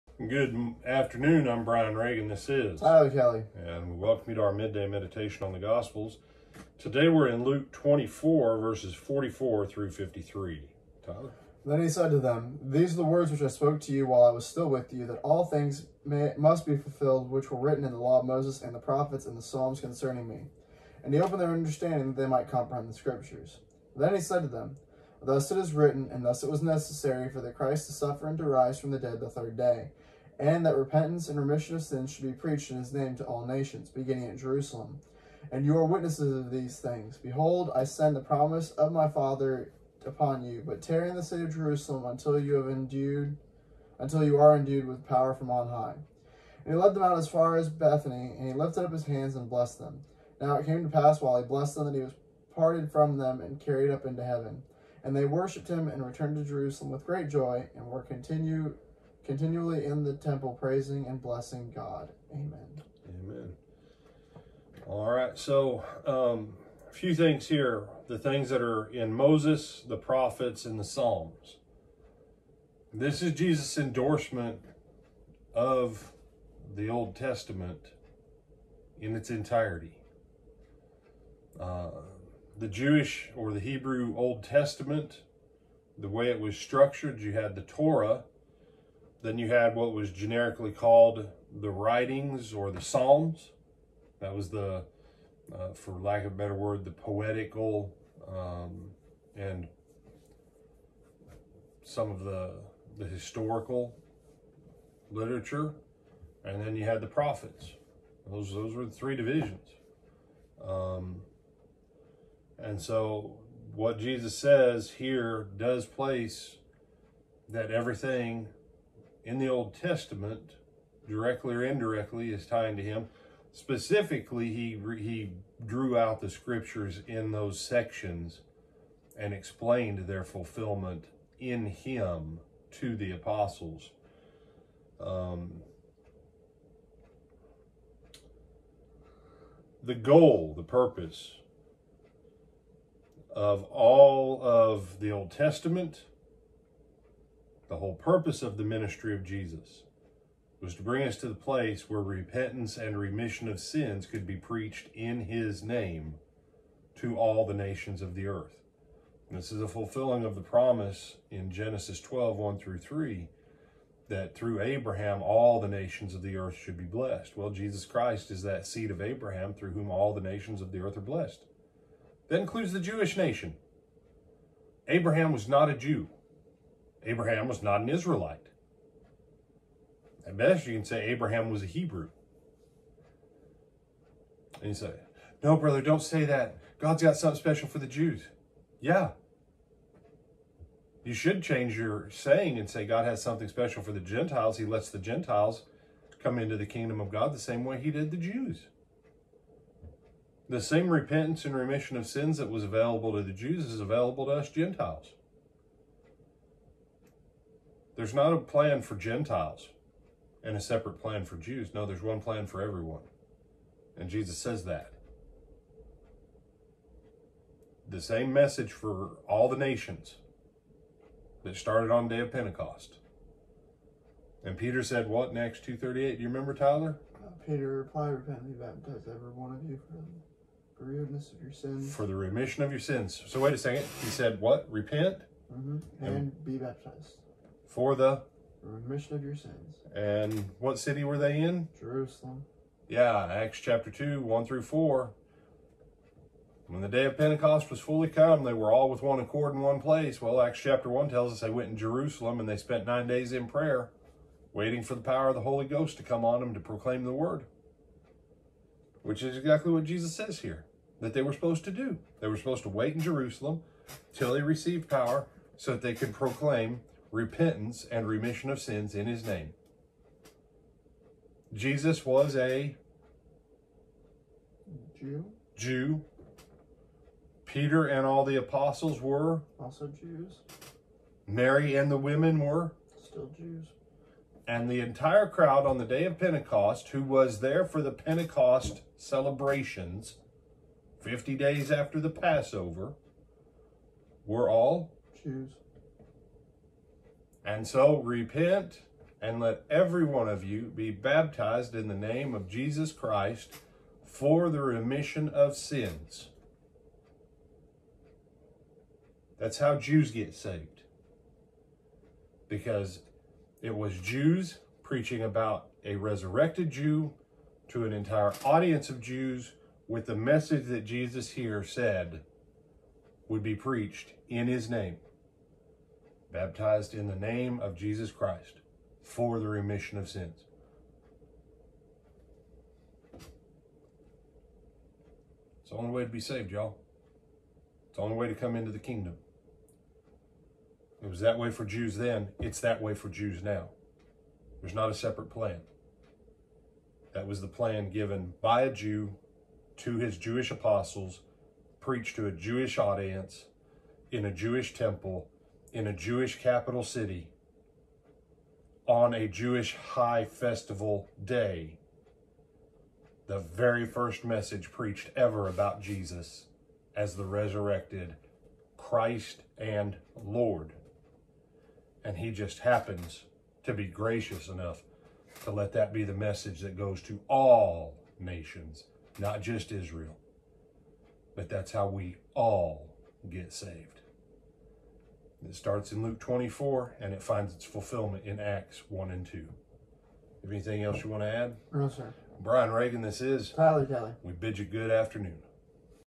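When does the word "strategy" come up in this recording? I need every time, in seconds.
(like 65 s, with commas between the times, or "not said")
not said.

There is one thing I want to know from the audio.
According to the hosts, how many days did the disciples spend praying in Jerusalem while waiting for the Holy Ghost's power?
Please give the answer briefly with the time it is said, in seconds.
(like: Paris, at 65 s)
9, at 252 s.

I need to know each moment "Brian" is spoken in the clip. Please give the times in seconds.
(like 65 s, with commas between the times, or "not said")
1 s, 392 s.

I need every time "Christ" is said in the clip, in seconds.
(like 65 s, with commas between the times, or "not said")
27 s, 167 s, 302 s, 328 s, 368 s.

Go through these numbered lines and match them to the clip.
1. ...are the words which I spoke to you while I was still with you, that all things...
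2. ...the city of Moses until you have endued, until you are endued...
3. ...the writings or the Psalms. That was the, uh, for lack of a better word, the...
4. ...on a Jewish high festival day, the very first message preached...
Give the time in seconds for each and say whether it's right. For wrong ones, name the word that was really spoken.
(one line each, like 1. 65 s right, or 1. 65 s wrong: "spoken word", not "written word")
1. 12 s right
2. 41 s wrong: "Jerusalem", not "Moses"
3. 91 s right
4. 358 s right.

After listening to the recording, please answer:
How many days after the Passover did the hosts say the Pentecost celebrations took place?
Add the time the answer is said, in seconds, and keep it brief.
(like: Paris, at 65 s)
50, at 291 s.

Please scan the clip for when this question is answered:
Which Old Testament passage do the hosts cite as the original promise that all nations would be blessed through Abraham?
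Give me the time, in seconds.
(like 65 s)
161 s.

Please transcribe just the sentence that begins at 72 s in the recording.
This is Jesus' endorsement of the Old Testament in its entirety.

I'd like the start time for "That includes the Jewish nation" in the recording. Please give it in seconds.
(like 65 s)
172 s.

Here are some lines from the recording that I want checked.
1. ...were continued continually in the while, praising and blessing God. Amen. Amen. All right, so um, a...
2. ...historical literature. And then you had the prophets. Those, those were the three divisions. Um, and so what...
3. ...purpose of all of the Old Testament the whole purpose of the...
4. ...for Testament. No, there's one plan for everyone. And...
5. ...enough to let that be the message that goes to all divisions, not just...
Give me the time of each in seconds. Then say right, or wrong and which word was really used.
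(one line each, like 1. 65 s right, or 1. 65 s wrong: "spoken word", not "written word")
1. 57 s wrong: "temple", not "while"
2. 103 s right
3. 140 s right
4. 211 s wrong: "Jews", not "Testament"
5. 374 s wrong: "nations", not "divisions".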